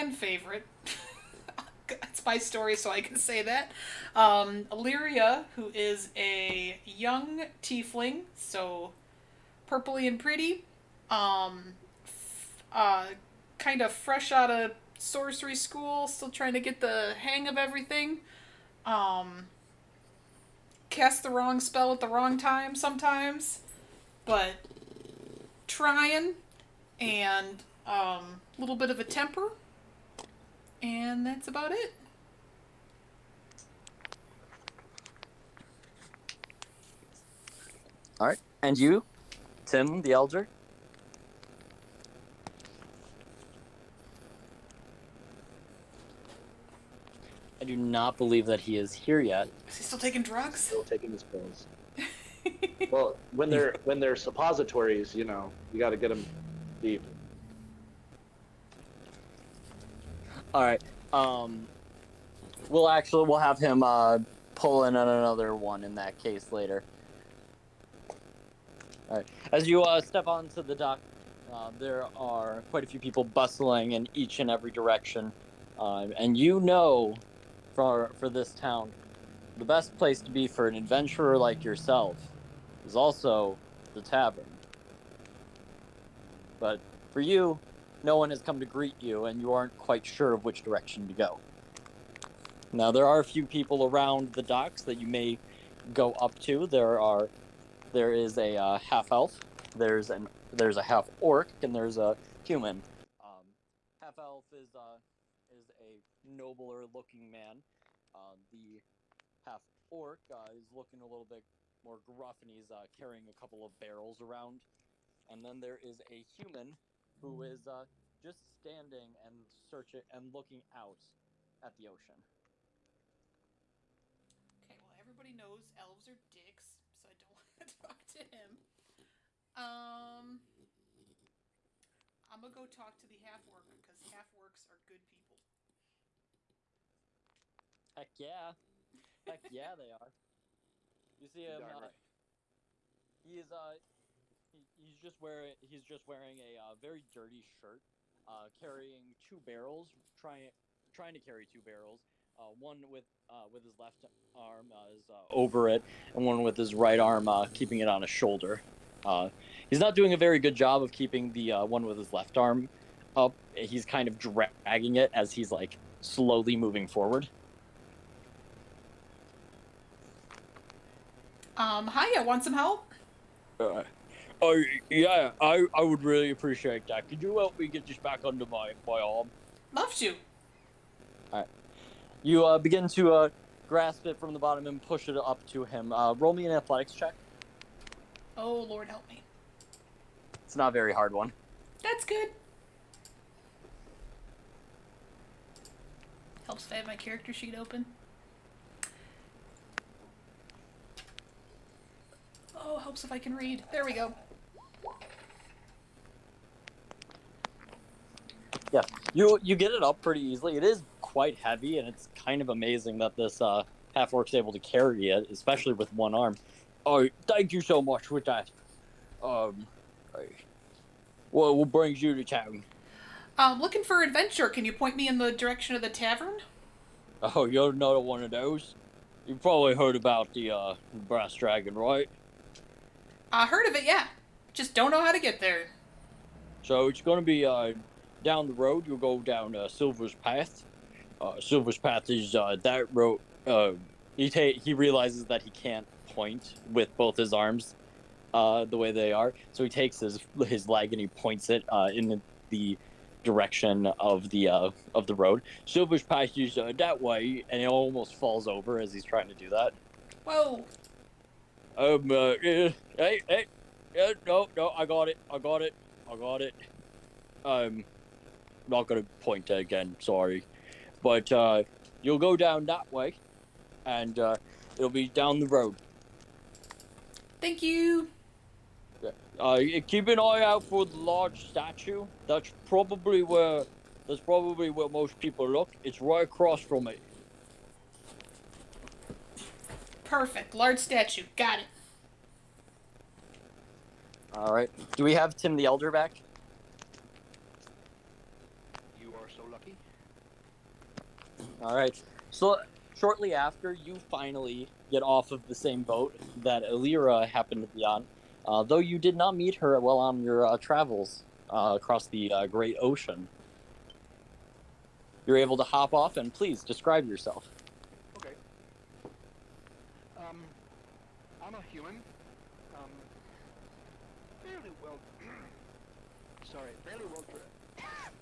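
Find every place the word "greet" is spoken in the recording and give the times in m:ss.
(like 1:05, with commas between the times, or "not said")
1:28.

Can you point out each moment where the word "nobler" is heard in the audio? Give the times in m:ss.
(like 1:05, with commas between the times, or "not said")
1:46.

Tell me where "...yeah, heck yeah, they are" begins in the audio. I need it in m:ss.
2:18.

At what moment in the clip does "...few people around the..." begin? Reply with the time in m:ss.
1:33.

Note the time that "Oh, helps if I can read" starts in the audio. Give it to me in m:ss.
3:22.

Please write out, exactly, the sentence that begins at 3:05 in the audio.
Uh, roll me an athletics check.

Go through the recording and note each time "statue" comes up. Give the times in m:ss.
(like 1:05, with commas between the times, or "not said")
4:41, 4:50.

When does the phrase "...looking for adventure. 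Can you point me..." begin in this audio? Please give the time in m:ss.
3:43.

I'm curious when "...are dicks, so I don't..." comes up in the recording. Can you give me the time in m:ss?
2:06.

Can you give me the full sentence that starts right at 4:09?
So he takes his his leg and he points it uh, in the, the direction of the uh, of the road.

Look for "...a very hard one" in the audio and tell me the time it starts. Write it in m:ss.
3:10.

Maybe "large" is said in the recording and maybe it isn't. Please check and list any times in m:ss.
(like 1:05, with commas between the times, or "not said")
4:40, 4:50.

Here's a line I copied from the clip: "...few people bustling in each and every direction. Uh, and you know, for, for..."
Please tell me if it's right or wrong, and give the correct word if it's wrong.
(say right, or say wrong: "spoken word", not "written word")
right.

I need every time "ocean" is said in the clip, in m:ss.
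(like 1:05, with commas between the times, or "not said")
2:01, 5:12.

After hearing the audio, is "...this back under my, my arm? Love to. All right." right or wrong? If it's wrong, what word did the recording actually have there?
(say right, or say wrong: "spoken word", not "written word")
right.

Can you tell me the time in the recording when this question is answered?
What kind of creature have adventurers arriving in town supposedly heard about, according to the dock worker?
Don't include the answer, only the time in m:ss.
3:51.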